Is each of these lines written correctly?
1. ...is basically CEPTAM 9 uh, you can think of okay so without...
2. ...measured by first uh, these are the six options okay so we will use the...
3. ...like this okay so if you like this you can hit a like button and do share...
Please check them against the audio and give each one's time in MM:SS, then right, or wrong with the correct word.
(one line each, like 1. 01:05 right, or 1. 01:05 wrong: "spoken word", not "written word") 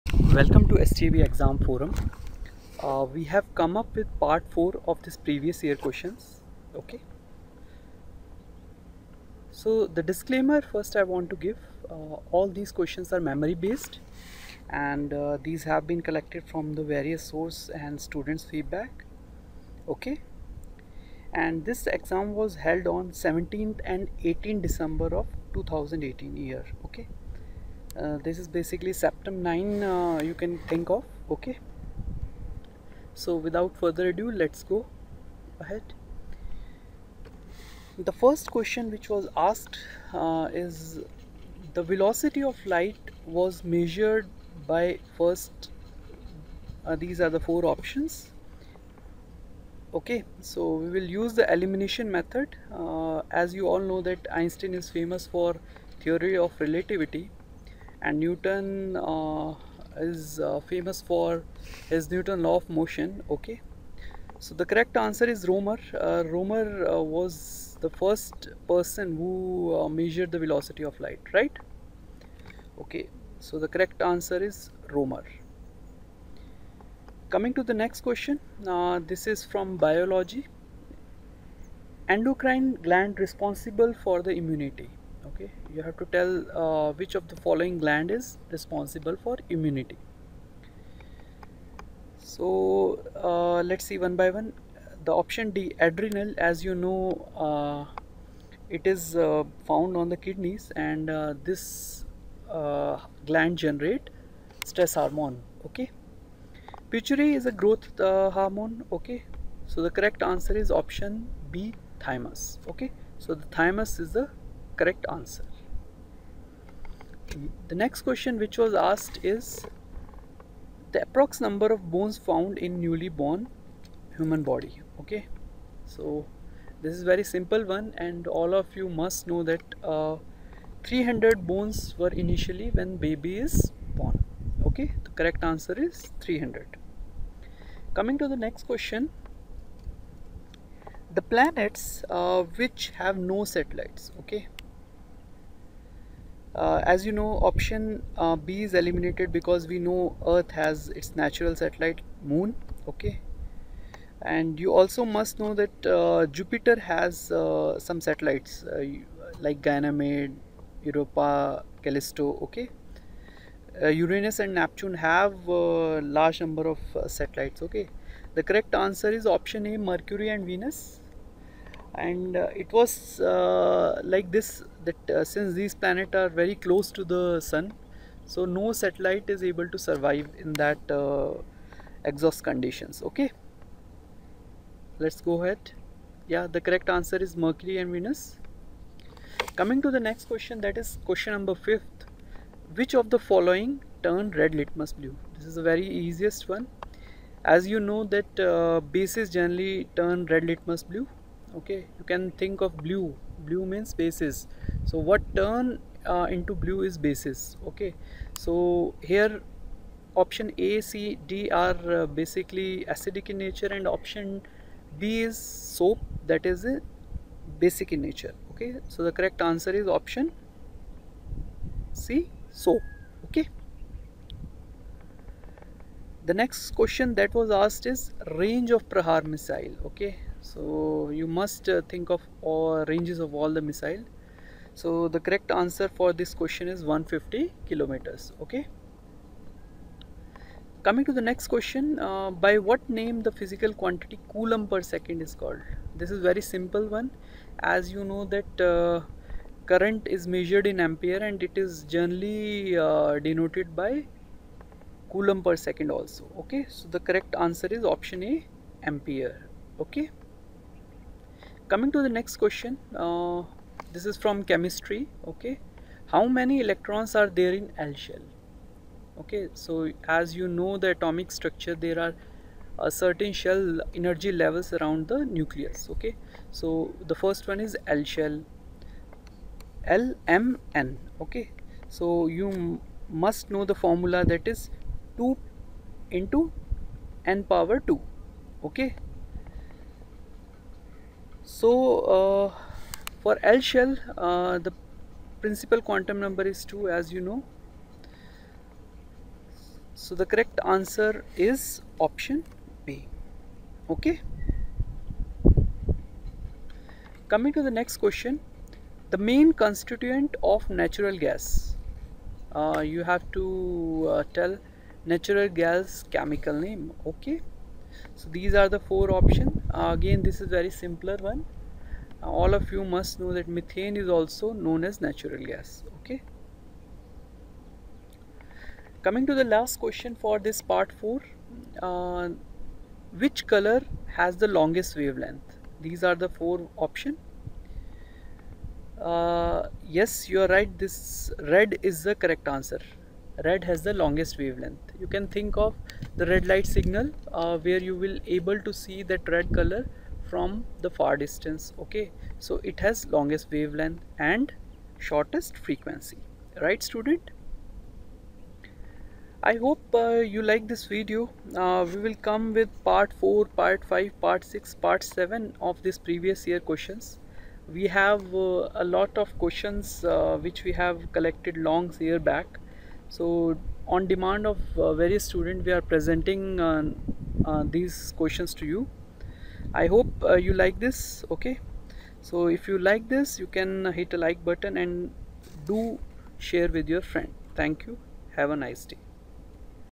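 1. 00:28 right
2. 00:43 wrong: "four", not "six"
3. 06:20 right.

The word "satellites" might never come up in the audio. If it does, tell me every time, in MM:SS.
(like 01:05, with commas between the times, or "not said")
02:23, 02:31, 02:38, 02:47, 02:58.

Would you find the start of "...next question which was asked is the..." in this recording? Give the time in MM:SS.
01:57.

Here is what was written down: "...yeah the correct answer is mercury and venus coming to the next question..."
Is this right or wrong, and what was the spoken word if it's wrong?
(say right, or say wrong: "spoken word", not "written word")
right.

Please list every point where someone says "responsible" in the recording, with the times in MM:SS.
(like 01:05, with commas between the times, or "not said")
01:23, 01:28.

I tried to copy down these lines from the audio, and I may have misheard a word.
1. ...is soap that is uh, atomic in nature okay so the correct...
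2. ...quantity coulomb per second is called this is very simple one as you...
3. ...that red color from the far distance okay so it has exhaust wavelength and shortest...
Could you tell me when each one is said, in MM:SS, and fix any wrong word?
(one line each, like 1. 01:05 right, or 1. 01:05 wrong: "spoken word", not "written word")
1. 03:35 wrong: "basic", not "atomic"
2. 04:03 right
3. 05:49 wrong: "longest", not "exhaust".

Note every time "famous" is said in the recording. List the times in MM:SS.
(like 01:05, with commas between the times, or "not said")
00:54, 01:00.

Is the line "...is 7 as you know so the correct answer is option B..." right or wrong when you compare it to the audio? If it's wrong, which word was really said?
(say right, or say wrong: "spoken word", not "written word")
wrong: "2", not "7".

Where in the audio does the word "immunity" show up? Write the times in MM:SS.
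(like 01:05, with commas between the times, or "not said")
01:24, 01:29.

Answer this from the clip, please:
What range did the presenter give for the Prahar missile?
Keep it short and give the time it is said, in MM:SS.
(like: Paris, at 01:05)
150 kilometers, at 03:56.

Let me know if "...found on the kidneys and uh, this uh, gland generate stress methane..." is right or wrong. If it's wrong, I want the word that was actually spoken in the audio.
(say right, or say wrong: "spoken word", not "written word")
wrong: "hormone", not "methane".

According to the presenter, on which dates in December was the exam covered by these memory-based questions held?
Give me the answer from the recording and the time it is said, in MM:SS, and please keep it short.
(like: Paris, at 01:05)
17th and 18th, at 00:23.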